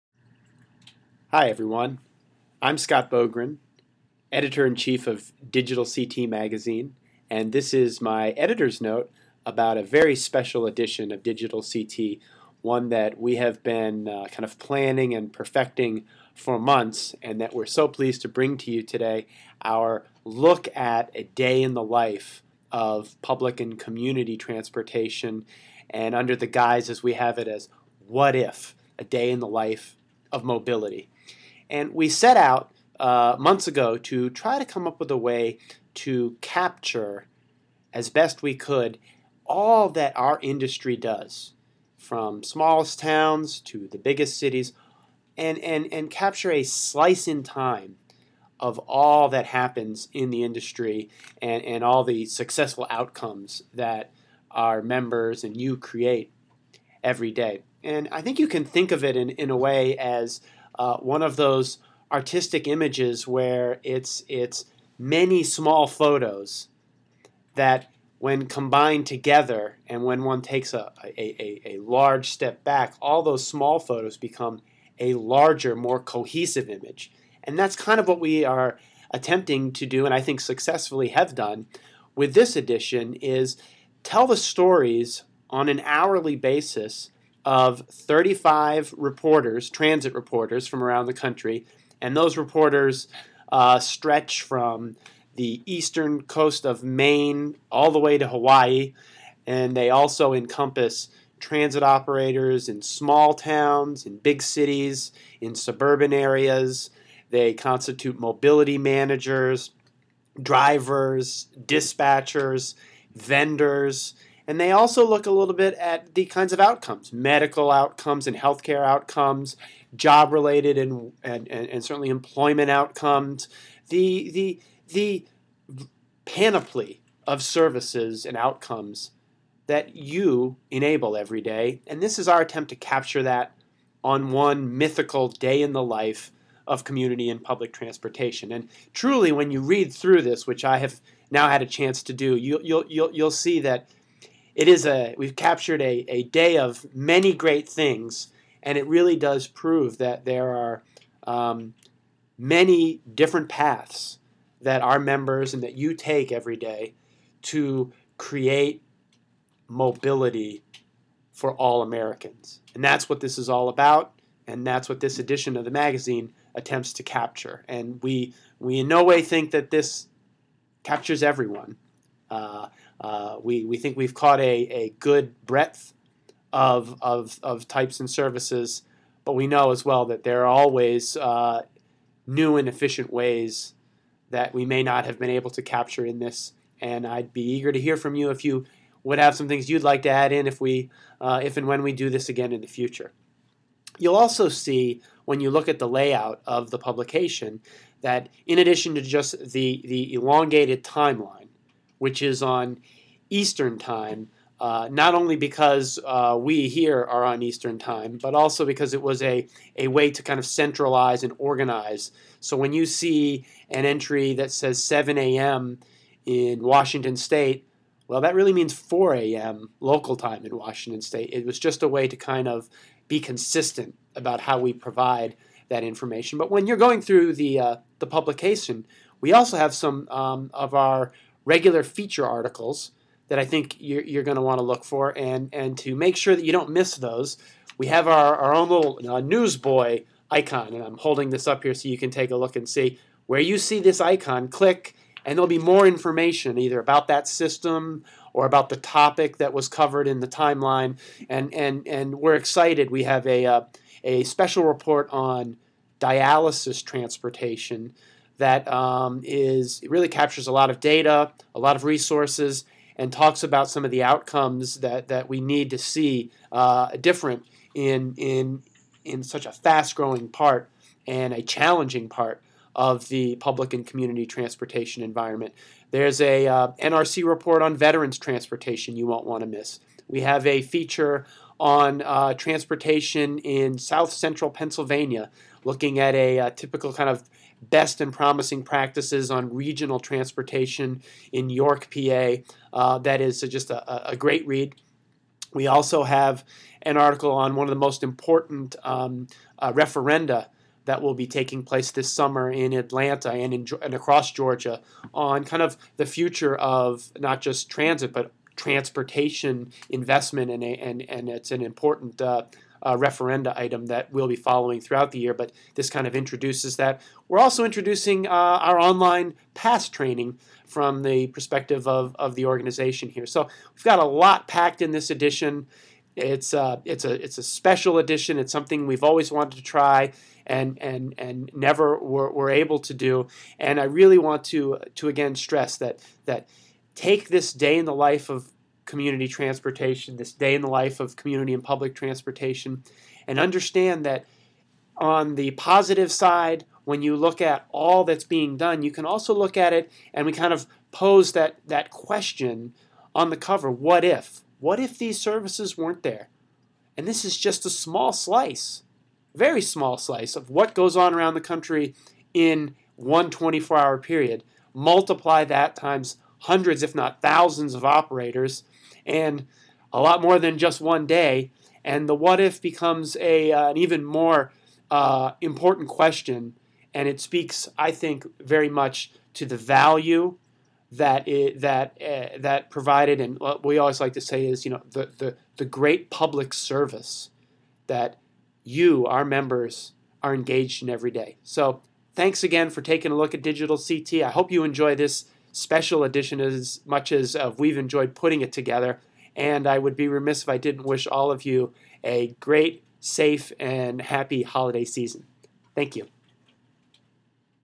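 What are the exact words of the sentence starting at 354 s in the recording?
What if these services weren't there?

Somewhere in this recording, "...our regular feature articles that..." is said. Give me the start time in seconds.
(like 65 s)
230 s.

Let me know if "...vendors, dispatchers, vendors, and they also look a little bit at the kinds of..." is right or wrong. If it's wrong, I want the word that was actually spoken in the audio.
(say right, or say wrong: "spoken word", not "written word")
wrong: "drivers", not "vendors".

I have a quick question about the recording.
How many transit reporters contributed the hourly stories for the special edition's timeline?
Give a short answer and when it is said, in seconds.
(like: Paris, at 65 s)
35, at 87 s.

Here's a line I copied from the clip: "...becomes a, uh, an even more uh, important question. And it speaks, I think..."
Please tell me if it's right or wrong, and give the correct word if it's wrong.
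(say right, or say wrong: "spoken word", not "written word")
right.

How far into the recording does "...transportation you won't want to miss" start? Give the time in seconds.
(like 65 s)
278 s.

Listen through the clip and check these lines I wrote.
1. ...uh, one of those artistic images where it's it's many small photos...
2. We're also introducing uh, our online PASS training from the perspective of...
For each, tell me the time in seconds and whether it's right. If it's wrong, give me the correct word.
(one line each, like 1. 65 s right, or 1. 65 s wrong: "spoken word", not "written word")
1. 60 s right
2. 317 s right.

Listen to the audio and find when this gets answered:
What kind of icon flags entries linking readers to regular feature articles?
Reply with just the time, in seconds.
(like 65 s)
239 s.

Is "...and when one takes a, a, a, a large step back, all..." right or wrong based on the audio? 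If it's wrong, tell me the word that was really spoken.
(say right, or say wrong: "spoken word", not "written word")
right.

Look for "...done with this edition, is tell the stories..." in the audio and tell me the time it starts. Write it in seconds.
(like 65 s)
81 s.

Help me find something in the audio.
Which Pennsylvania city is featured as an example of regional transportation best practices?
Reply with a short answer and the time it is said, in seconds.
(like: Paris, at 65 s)
York, at 291 s.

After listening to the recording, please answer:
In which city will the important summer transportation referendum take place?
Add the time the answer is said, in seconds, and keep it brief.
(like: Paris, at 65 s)
Atlanta, at 302 s.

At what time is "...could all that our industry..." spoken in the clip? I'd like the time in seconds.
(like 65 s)
38 s.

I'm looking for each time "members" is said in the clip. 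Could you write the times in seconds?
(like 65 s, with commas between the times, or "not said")
54 s, 154 s, 389 s.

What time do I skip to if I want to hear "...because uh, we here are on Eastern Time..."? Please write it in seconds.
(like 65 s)
205 s.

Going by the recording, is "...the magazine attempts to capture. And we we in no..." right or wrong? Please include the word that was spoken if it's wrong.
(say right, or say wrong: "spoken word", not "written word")
right.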